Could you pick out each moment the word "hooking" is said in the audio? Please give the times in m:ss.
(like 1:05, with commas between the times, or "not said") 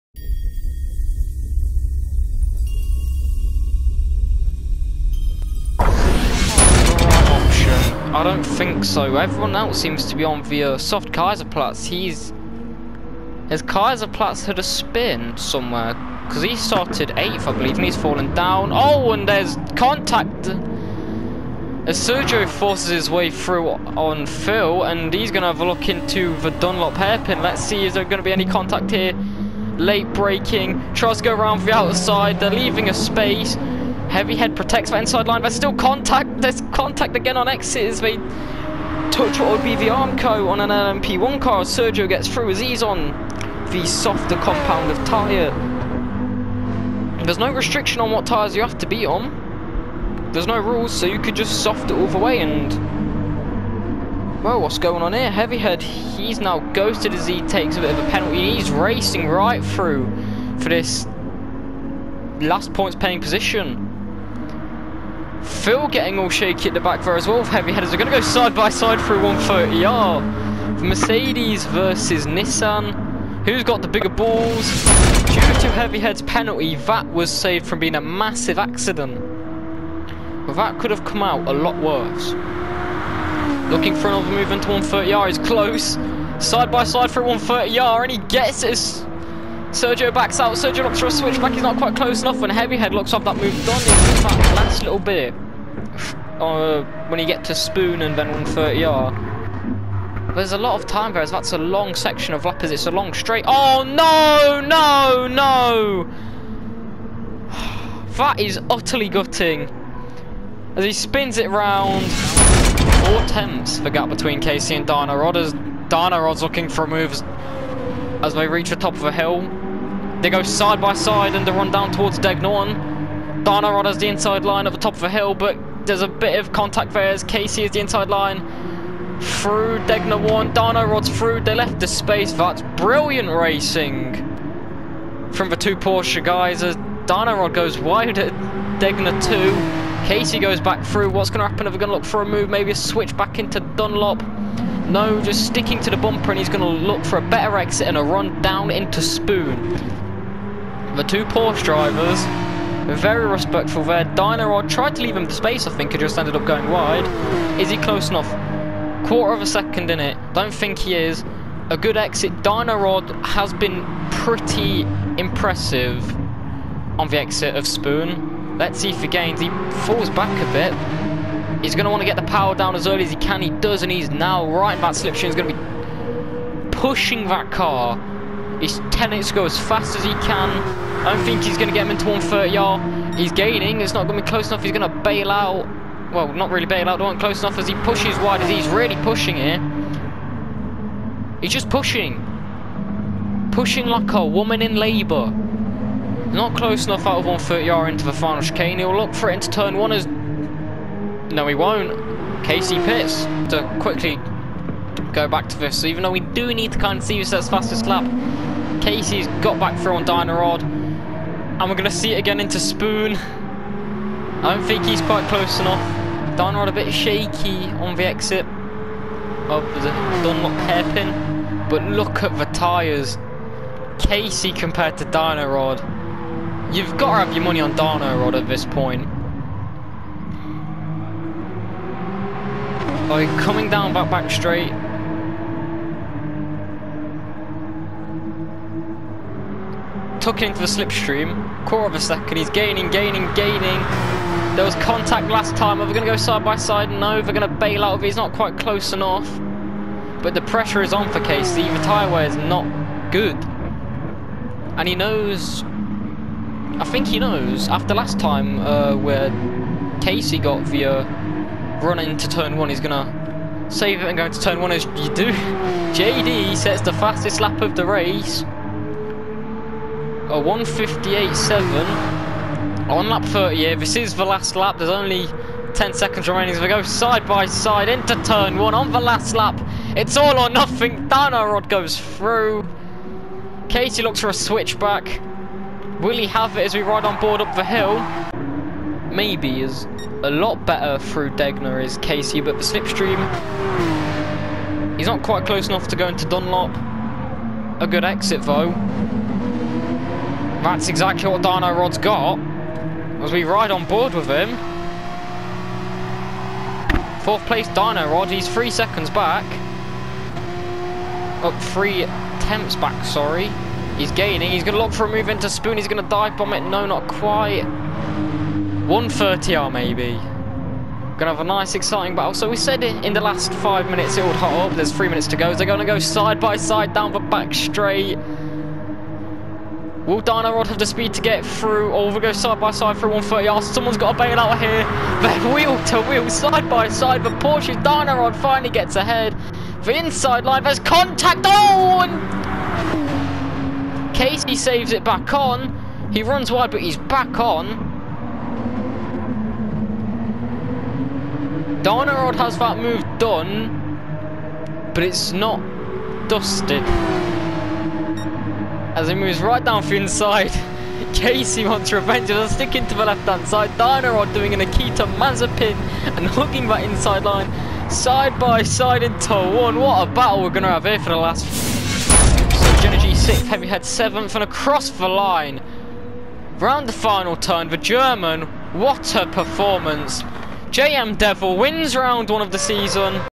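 6:06.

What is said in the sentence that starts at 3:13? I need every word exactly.
Pushing like a woman in labour.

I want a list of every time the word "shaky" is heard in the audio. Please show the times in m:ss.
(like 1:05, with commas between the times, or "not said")
1:06, 3:36.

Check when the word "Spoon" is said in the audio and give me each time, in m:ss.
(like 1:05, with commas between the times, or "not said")
1:37, 2:29, 2:47, 3:32, 5:15.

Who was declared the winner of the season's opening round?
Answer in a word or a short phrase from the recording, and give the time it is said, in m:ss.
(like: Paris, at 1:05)
JM Devil, at 6:20.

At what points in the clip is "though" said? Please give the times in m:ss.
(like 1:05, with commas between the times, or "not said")
3:26, 4:58.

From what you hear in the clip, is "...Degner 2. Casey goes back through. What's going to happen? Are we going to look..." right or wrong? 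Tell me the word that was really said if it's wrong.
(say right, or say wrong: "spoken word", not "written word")
right.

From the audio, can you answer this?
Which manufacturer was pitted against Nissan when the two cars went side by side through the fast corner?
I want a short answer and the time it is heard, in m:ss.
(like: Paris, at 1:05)
Mercedes, at 1:10.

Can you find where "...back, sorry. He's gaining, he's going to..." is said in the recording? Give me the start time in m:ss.
5:12.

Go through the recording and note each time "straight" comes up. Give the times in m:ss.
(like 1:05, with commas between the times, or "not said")
1:43, 3:54, 5:27.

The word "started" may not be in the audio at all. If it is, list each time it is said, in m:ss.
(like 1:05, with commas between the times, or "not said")
0:16.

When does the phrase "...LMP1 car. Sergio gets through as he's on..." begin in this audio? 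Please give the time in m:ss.
0:40.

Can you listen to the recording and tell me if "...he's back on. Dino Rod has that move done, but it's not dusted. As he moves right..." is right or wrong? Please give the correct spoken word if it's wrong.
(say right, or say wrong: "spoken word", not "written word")
right.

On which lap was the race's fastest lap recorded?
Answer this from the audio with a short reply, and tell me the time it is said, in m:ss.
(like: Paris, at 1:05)
38, at 4:33.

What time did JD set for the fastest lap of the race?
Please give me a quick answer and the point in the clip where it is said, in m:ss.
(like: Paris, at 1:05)
1:58.7, at 4:30.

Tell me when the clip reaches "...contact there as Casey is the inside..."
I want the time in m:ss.
2:06.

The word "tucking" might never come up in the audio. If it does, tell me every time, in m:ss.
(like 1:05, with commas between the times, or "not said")
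4:00.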